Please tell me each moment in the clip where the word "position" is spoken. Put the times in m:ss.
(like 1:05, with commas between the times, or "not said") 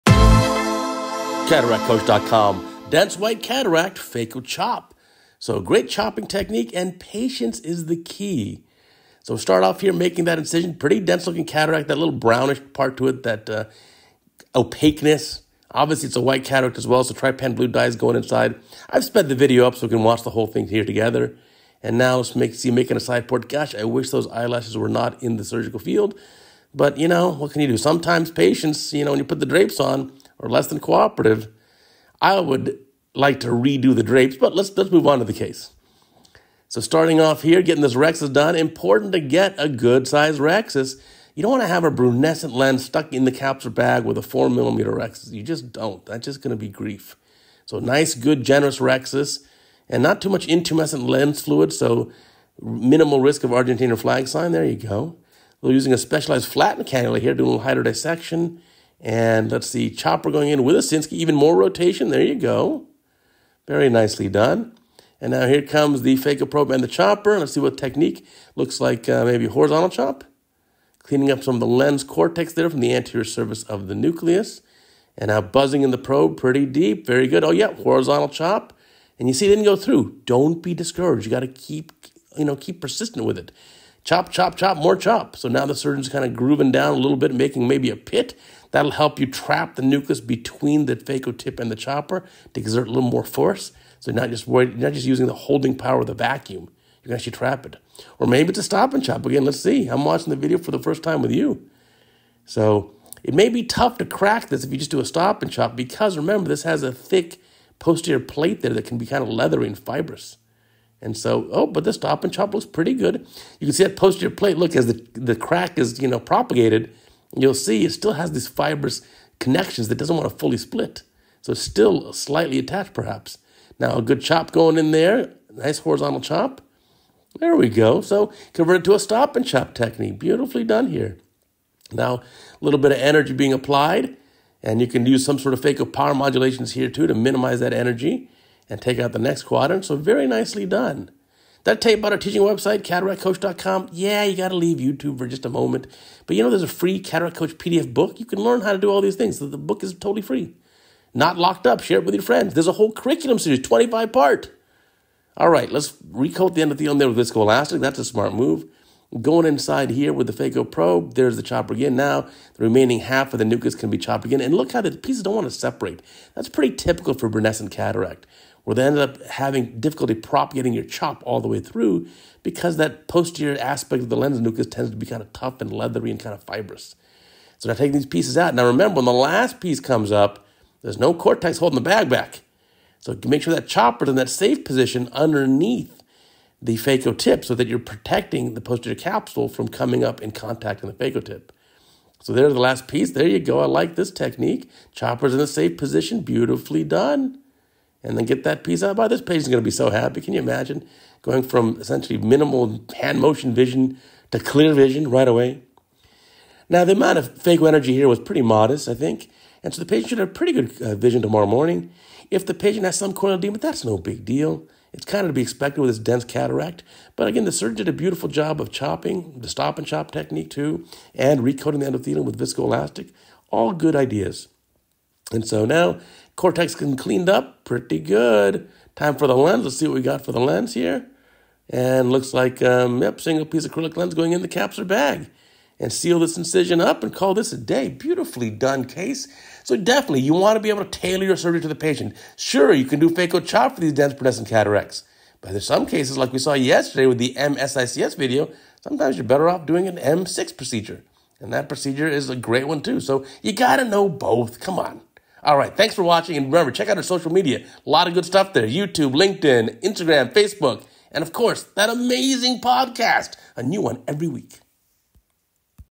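3:04, 3:15.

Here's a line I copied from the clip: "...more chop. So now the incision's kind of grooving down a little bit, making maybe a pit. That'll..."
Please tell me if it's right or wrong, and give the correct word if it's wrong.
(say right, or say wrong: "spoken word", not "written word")
wrong: "surgeon", not "incision".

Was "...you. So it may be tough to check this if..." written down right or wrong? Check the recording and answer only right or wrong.
wrong.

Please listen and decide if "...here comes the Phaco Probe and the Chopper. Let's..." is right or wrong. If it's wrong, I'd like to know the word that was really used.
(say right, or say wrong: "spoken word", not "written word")
right.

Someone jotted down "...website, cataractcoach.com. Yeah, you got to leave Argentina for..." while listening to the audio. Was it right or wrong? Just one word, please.
wrong.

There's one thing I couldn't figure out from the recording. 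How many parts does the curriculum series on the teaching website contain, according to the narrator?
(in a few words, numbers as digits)
25.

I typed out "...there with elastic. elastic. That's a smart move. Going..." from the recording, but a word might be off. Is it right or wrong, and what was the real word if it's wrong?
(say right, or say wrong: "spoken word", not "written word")
wrong: "viscoelastic", not "elastic".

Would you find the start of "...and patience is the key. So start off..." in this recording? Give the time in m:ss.
0:06.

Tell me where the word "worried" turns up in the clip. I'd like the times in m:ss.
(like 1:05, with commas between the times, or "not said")
1:34.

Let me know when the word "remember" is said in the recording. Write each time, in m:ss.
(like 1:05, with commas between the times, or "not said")
1:46, 2:58, 4:16.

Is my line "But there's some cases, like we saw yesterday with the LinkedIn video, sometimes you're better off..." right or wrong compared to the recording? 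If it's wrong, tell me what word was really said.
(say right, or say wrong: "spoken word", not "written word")
wrong: "MSICS", not "LinkedIn".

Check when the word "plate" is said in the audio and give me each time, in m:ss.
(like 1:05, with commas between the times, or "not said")
1:48, 1:54.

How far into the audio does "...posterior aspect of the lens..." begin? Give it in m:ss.
2:53.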